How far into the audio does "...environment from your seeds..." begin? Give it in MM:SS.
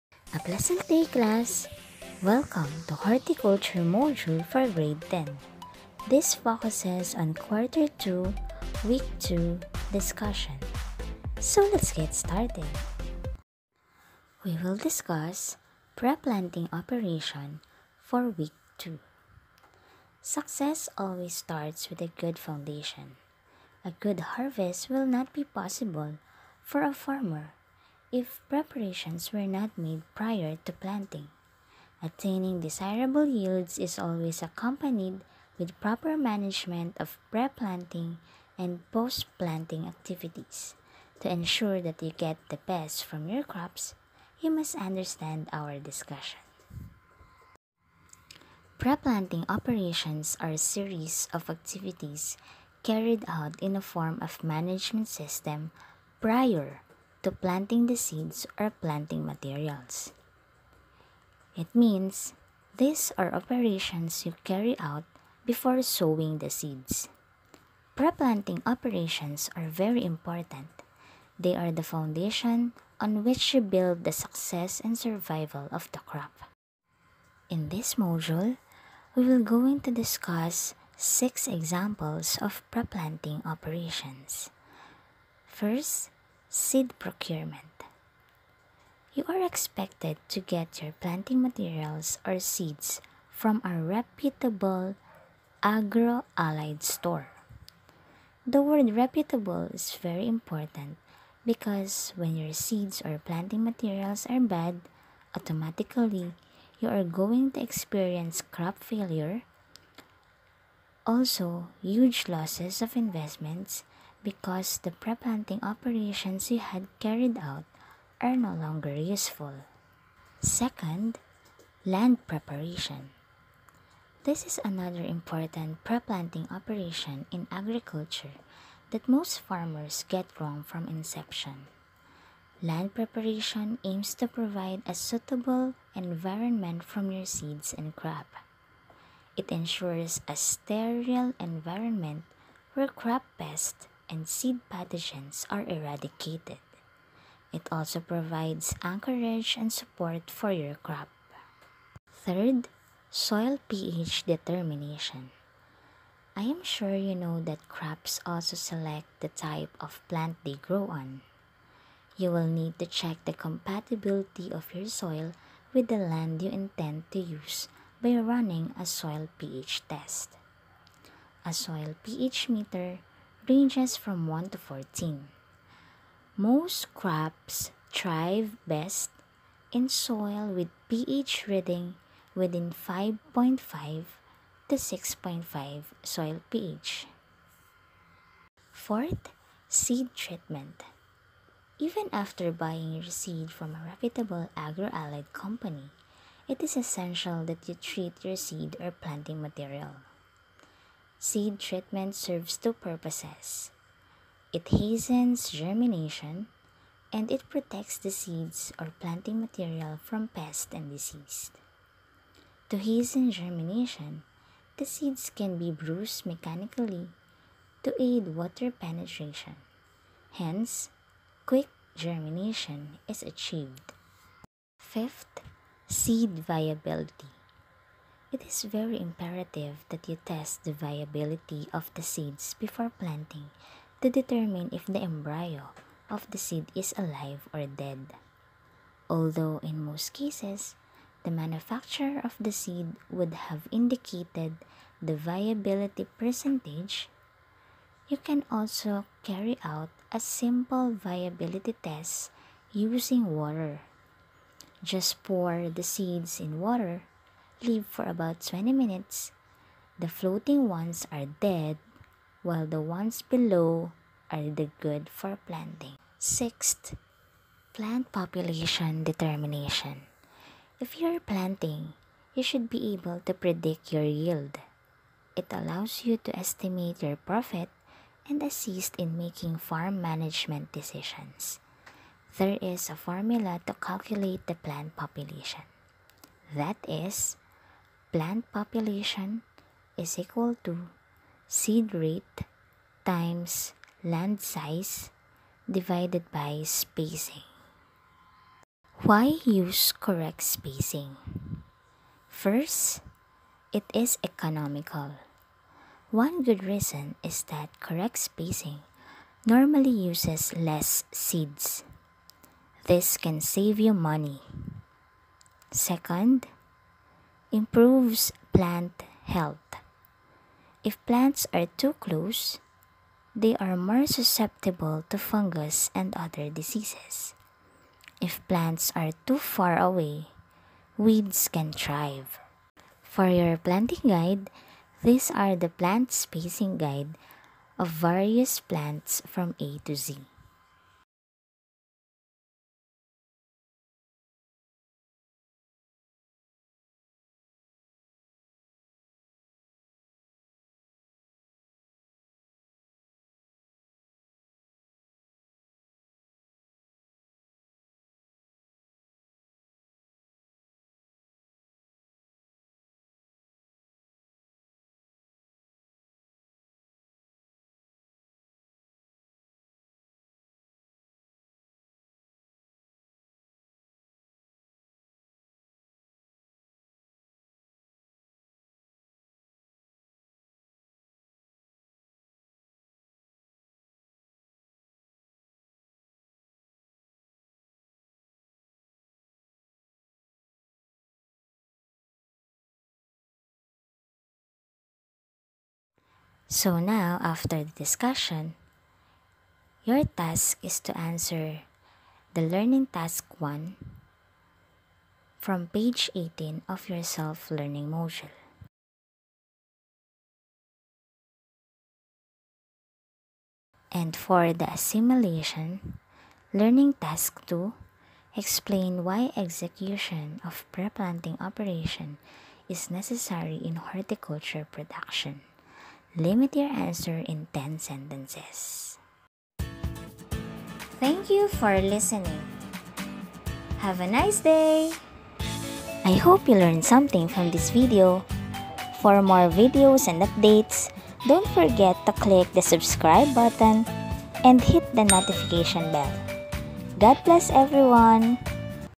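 02:15.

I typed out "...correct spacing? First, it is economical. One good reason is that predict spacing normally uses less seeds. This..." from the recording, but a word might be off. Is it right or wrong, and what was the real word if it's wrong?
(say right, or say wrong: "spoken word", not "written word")
wrong: "correct", not "predict".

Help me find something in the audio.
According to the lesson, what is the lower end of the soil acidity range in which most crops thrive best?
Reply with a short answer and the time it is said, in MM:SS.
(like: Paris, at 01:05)
5.5, at 03:02.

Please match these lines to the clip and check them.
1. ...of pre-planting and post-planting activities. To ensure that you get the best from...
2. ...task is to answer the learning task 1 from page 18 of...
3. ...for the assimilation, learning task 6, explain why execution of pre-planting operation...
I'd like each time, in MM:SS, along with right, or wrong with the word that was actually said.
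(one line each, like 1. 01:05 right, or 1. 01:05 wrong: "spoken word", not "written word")
1. 00:36 right
2. 06:40 right
3. 06:54 wrong: "2", not "6".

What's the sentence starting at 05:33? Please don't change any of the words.
For your planting guide, these are the plant spacing guide of various plants from A to Z.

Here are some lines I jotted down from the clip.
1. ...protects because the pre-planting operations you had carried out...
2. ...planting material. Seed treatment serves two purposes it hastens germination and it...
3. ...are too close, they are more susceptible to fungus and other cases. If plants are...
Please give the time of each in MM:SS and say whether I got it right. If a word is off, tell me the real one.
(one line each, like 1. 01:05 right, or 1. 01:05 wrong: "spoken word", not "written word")
1. 01:52 wrong: "investments", not "protects"
2. 03:18 right
3. 05:21 wrong: "diseases", not "cases".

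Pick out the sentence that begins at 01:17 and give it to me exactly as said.
In this module, we will go into discuss six examples of pre-planting operations.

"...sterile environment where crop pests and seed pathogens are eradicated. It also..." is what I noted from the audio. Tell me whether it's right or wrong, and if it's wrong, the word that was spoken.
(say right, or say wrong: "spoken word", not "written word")
right.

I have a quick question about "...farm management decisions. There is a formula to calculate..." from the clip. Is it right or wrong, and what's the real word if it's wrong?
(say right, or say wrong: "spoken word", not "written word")
right.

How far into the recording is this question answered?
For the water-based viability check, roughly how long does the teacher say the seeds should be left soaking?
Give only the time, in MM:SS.
04:18.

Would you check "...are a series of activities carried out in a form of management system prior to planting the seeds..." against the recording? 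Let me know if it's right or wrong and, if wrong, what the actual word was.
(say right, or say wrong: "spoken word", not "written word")
right.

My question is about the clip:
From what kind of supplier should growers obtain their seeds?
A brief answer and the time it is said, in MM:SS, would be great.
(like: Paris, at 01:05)
reputable agro allied store, at 01:33.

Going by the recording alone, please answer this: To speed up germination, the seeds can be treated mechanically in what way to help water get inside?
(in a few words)
bruised.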